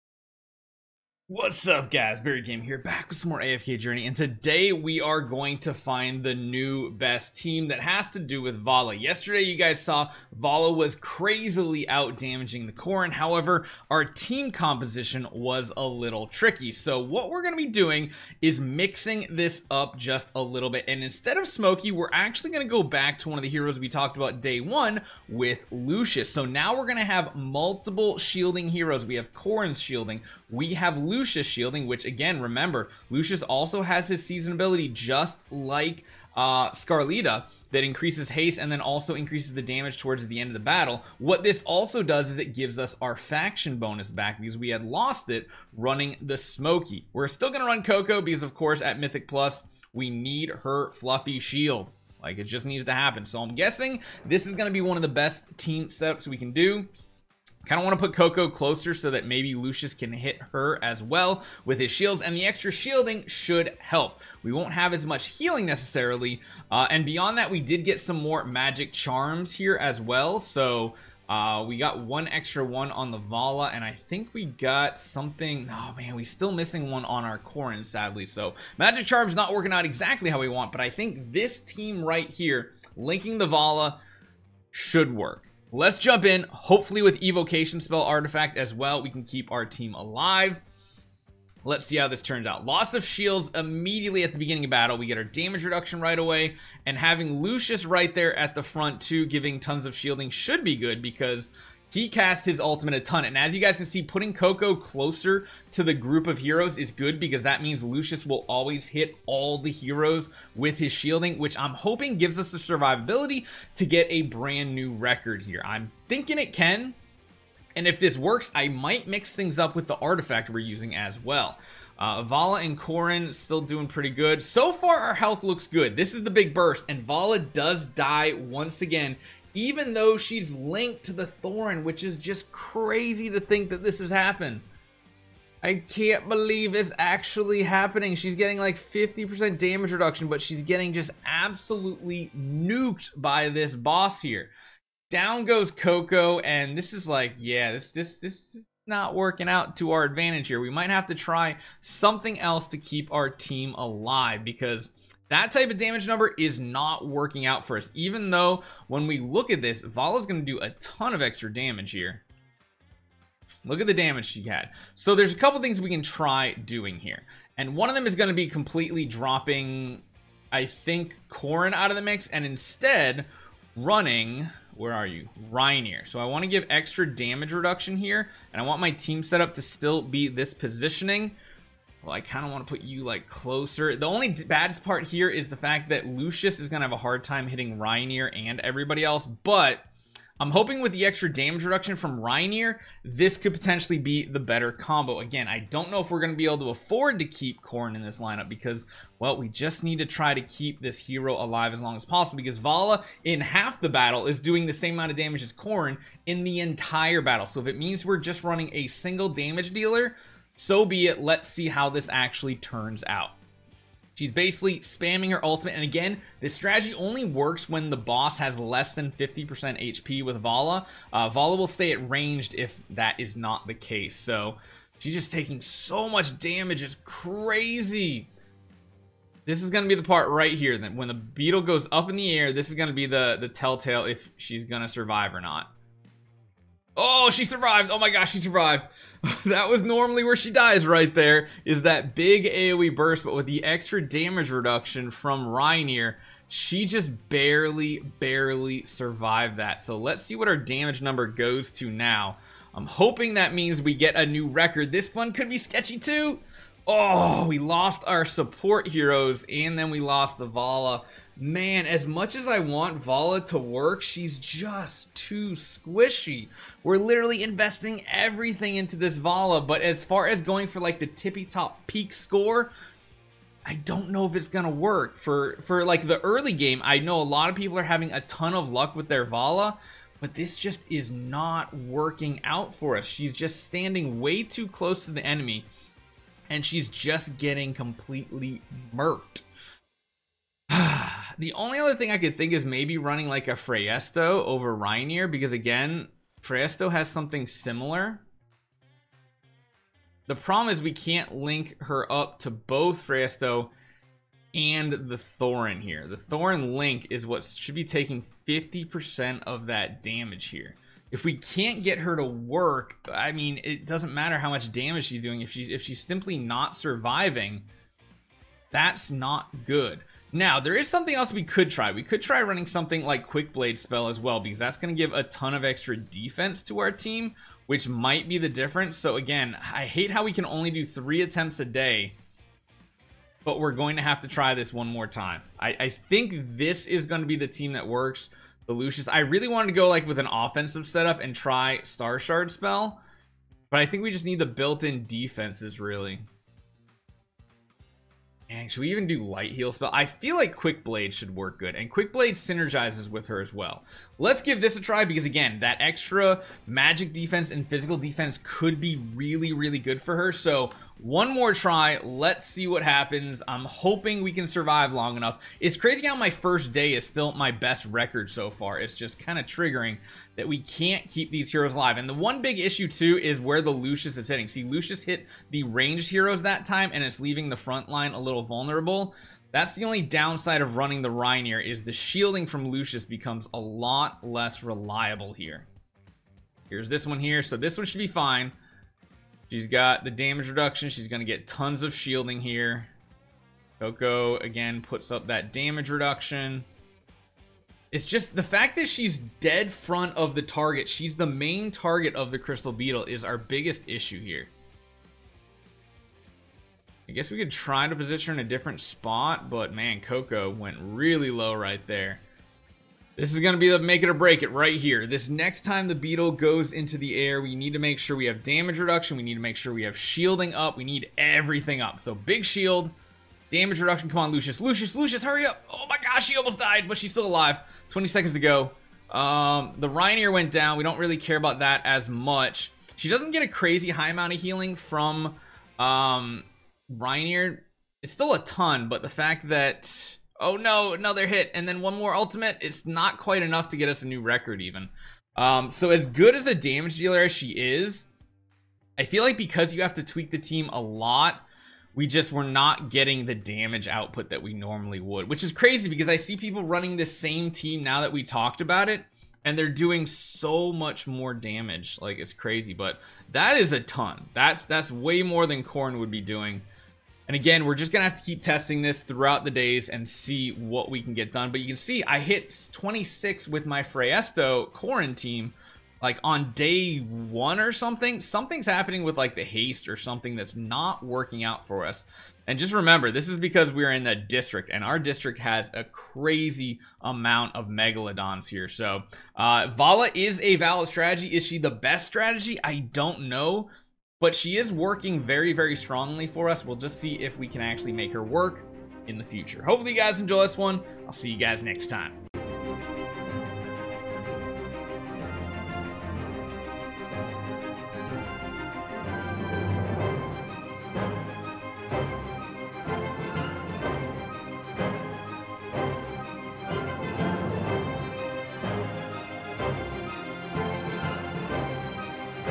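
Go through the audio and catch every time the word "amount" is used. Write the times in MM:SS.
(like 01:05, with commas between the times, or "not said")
03:24, 07:14, 08:06.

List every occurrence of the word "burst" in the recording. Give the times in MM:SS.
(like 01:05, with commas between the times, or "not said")
02:06, 04:02.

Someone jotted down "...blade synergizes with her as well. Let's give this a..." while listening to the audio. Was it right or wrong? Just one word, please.
right.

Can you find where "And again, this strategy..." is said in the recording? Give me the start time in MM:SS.
03:35.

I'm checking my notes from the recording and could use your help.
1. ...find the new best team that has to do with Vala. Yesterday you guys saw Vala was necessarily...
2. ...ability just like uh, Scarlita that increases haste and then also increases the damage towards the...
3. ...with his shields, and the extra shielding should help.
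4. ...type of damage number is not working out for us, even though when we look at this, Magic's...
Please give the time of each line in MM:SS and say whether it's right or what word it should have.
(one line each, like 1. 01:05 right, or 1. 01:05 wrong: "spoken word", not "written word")
1. 00:05 wrong: "crazily", not "necessarily"
2. 00:34 right
3. 01:01 right
4. 02:35 wrong: "Vala", not "Magic".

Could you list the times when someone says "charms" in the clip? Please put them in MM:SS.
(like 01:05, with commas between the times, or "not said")
01:08, 01:19.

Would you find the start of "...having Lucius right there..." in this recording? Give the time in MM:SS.
01:36.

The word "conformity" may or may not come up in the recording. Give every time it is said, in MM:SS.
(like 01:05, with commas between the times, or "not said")
not said.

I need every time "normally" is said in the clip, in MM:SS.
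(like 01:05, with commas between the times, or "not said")
03:59, 07:34.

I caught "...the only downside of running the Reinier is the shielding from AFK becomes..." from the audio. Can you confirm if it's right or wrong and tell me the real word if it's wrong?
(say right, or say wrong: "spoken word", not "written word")
wrong: "Lucius", not "AFK".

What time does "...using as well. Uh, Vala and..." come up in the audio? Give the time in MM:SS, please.
02:00.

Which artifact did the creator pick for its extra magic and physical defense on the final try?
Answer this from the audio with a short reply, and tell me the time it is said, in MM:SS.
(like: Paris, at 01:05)
Quick Blade Spell, at 05:23.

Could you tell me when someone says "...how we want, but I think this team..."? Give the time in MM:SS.
01:20.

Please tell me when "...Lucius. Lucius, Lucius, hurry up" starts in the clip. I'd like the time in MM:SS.
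07:04.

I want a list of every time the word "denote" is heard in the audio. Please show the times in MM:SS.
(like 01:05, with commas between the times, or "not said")
not said.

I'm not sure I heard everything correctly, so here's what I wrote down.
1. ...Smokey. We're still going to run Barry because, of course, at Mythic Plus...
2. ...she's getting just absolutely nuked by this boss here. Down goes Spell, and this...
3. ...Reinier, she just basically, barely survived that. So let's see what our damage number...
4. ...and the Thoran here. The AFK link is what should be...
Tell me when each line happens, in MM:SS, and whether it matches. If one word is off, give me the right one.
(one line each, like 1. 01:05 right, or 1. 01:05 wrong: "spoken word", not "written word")
1. 00:46 wrong: "Koko", not "Barry"
2. 02:20 wrong: "Koko", not "Spell"
3. 04:05 wrong: "barely", not "basically"
4. 05:04 wrong: "Thoran", not "AFK".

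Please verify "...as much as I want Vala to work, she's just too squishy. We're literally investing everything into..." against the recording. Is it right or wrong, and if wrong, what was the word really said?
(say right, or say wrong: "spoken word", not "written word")
right.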